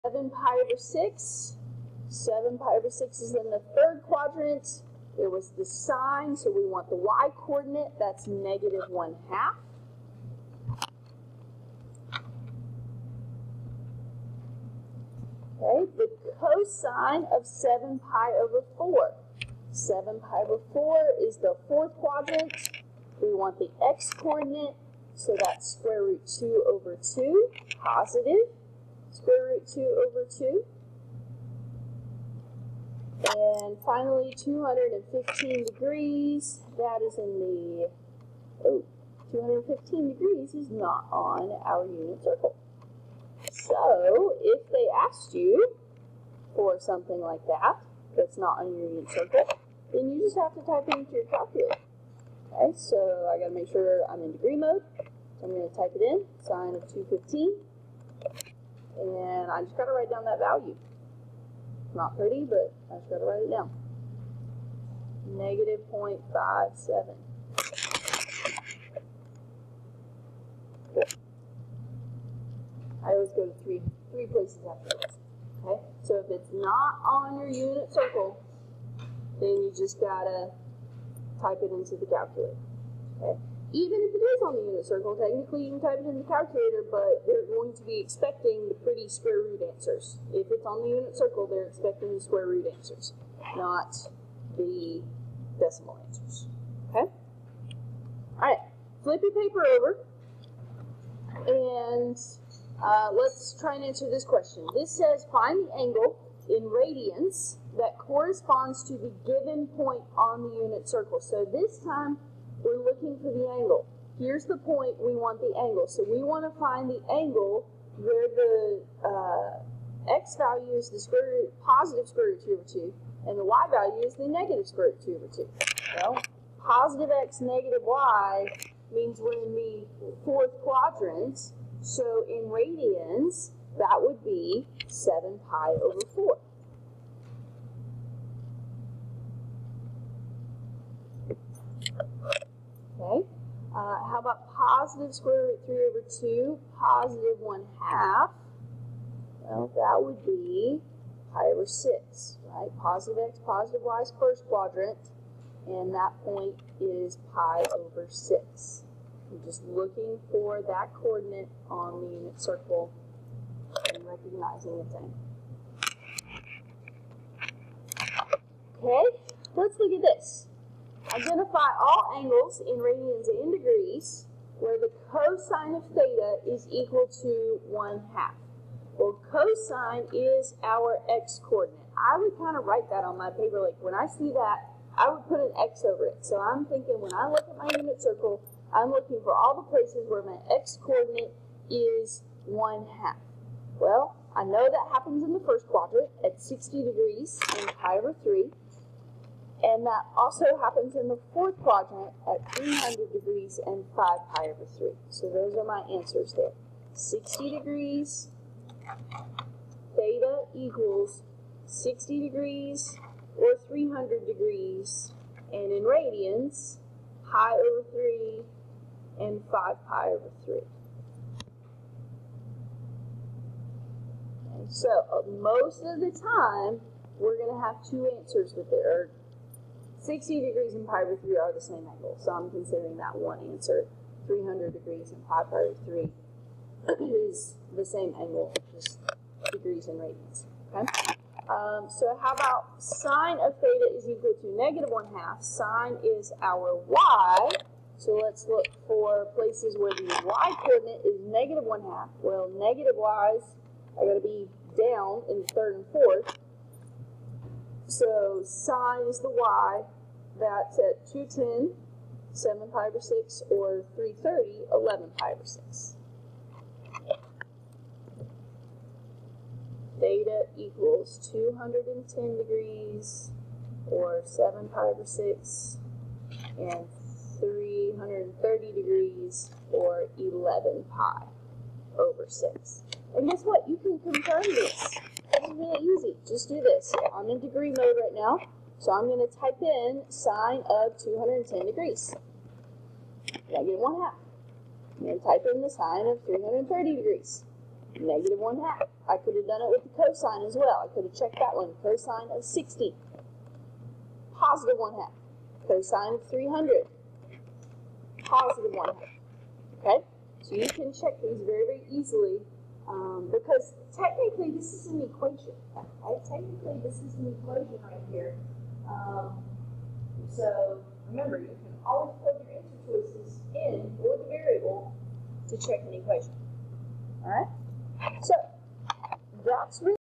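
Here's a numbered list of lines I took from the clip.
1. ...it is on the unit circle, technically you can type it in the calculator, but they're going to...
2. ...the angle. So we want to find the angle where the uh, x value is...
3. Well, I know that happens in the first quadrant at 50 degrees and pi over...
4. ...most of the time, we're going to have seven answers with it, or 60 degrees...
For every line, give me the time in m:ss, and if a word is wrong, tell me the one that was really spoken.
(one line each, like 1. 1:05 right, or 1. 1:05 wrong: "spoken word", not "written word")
1. 1:24 right
2. 1:55 right
3. 3:13 wrong: "60", not "50"
4. 3:45 wrong: "two", not "seven".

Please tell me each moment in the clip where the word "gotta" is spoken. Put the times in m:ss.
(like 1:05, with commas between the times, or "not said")
0:53, 1:19.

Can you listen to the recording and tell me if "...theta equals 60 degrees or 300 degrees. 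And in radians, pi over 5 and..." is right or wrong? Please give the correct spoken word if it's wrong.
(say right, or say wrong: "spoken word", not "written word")
wrong: "3", not "5".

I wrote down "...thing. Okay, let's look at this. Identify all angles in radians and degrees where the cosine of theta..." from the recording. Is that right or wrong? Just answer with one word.
right.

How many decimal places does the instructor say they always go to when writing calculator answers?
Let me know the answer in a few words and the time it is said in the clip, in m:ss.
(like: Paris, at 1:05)
3, at 1:14.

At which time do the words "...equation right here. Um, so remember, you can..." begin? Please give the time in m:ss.
5:17.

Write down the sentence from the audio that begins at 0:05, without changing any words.
It was the sine, so we want the y coordinate.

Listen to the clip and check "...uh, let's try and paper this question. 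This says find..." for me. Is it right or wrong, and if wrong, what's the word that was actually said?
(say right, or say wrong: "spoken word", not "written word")
wrong: "answer", not "paper".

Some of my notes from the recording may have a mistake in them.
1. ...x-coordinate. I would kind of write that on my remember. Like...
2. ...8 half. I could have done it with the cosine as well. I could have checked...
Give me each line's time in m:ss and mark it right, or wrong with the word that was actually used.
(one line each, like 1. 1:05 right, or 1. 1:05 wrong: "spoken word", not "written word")
1. 3:01 wrong: "paper", not "remember"
2. 4:58 wrong: "1", not "8".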